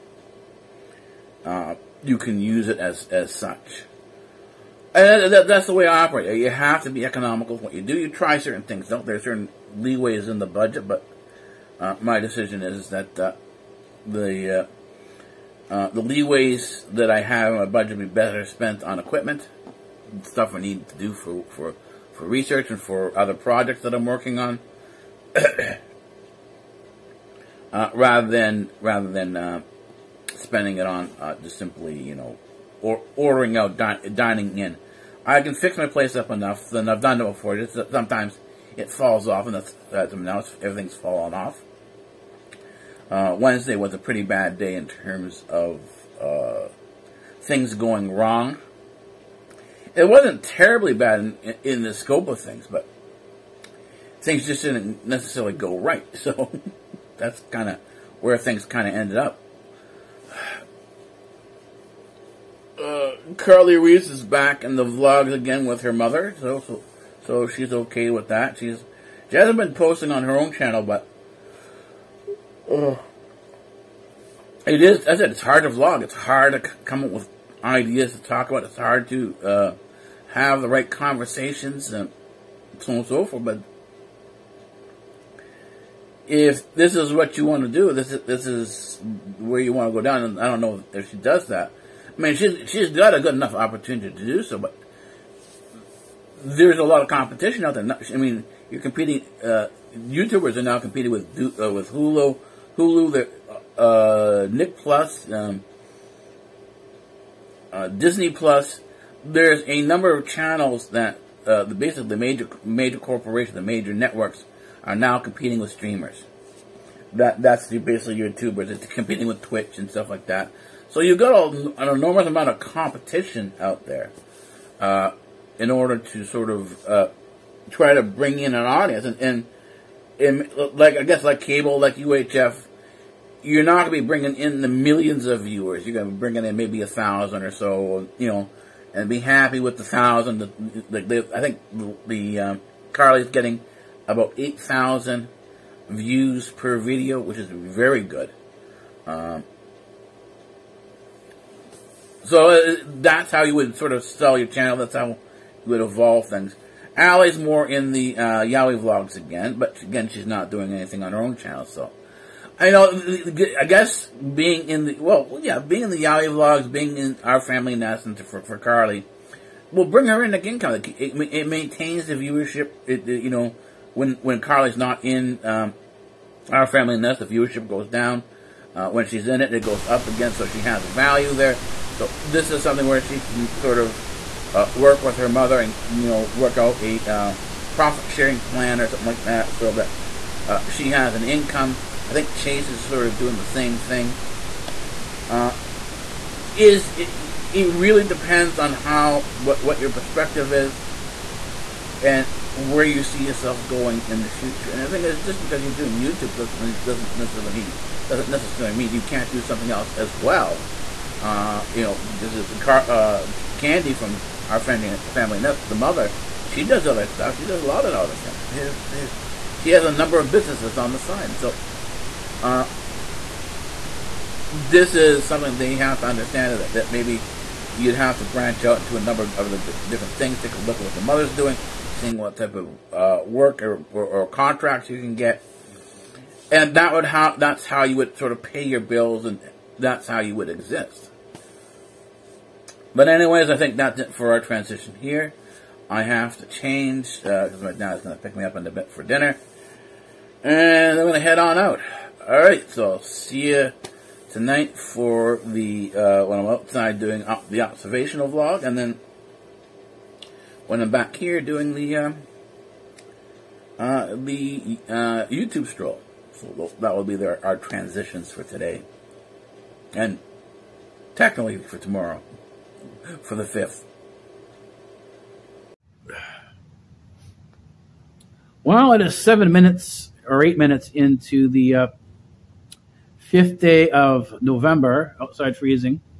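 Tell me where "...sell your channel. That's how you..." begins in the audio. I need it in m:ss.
2:34.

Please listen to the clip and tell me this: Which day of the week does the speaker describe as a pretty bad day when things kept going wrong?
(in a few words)
Wednesday.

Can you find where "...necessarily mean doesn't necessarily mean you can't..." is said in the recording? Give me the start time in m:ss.
3:27.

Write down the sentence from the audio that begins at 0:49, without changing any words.
It wasn't terribly bad in, in, the scope of things, but things just didn't necessarily go right.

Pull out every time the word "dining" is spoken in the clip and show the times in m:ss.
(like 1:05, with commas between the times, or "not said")
0:34.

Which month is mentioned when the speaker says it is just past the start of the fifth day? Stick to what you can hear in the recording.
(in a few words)
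November.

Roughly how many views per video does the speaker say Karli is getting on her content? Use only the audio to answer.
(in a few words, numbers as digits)
8,000.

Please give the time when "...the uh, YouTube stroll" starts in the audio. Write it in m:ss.
4:24.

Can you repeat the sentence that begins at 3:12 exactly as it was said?
I think Chase is sort of doing the same thing.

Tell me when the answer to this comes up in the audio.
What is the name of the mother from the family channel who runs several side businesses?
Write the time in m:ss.
3:33.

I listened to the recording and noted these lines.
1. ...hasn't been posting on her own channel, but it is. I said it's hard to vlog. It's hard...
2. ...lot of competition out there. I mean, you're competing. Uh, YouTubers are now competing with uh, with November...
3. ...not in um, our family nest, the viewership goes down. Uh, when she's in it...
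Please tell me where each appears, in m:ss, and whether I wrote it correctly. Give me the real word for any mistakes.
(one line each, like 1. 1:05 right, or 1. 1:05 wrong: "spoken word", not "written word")
1. 1:09 right
2. 1:36 wrong: "Hulu", not "November"
3. 2:54 right.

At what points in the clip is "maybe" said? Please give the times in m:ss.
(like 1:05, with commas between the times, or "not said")
2:16, 3:46.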